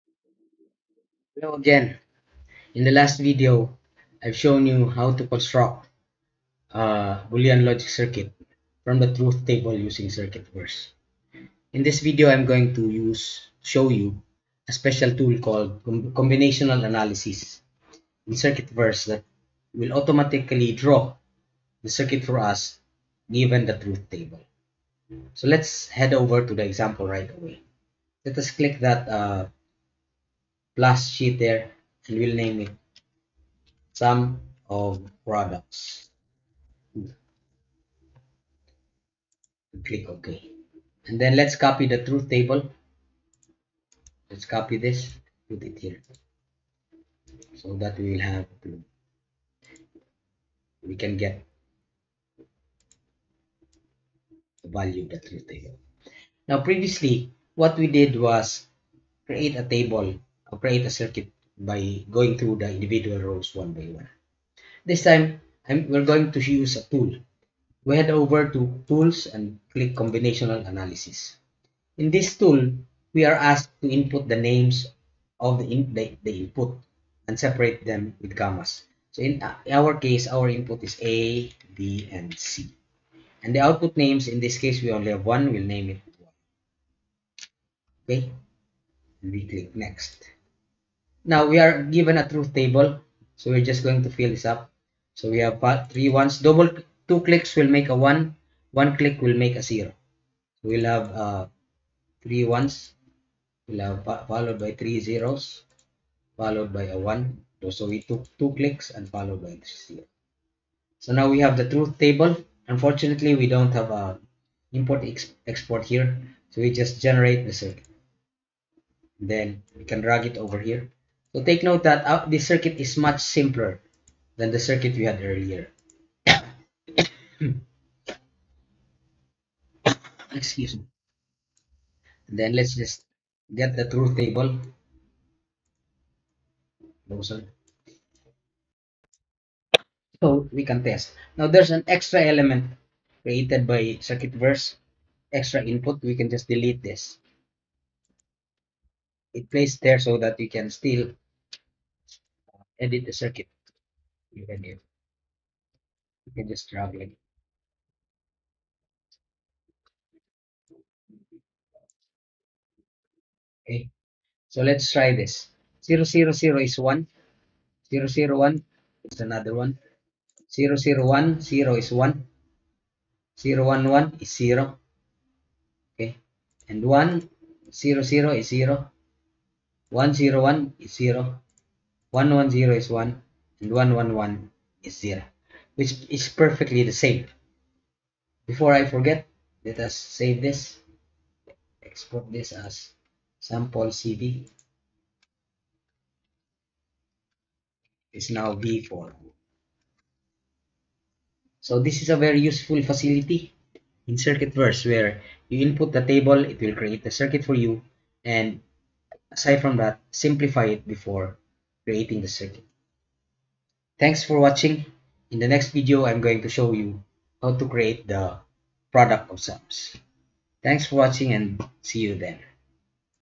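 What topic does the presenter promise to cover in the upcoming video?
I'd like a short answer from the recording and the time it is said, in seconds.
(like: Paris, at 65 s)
product of sums, at 218 s.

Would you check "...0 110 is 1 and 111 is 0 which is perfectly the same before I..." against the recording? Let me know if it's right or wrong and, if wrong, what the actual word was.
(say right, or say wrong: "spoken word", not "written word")
right.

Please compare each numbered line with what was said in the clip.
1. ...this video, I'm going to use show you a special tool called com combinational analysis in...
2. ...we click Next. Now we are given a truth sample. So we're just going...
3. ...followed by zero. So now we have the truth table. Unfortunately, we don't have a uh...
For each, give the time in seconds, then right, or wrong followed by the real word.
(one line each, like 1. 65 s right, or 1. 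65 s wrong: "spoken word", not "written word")
1. 11 s right
2. 89 s wrong: "table", not "sample"
3. 109 s right.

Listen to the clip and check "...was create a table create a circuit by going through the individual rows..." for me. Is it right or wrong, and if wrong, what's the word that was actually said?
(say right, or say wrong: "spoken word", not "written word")
right.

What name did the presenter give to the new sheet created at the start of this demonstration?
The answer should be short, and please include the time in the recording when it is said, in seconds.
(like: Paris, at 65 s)
sum of products, at 33 s.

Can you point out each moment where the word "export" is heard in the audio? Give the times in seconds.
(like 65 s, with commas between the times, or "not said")
115 s, 191 s.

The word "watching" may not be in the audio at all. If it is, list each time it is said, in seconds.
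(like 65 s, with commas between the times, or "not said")
214 s, 220 s.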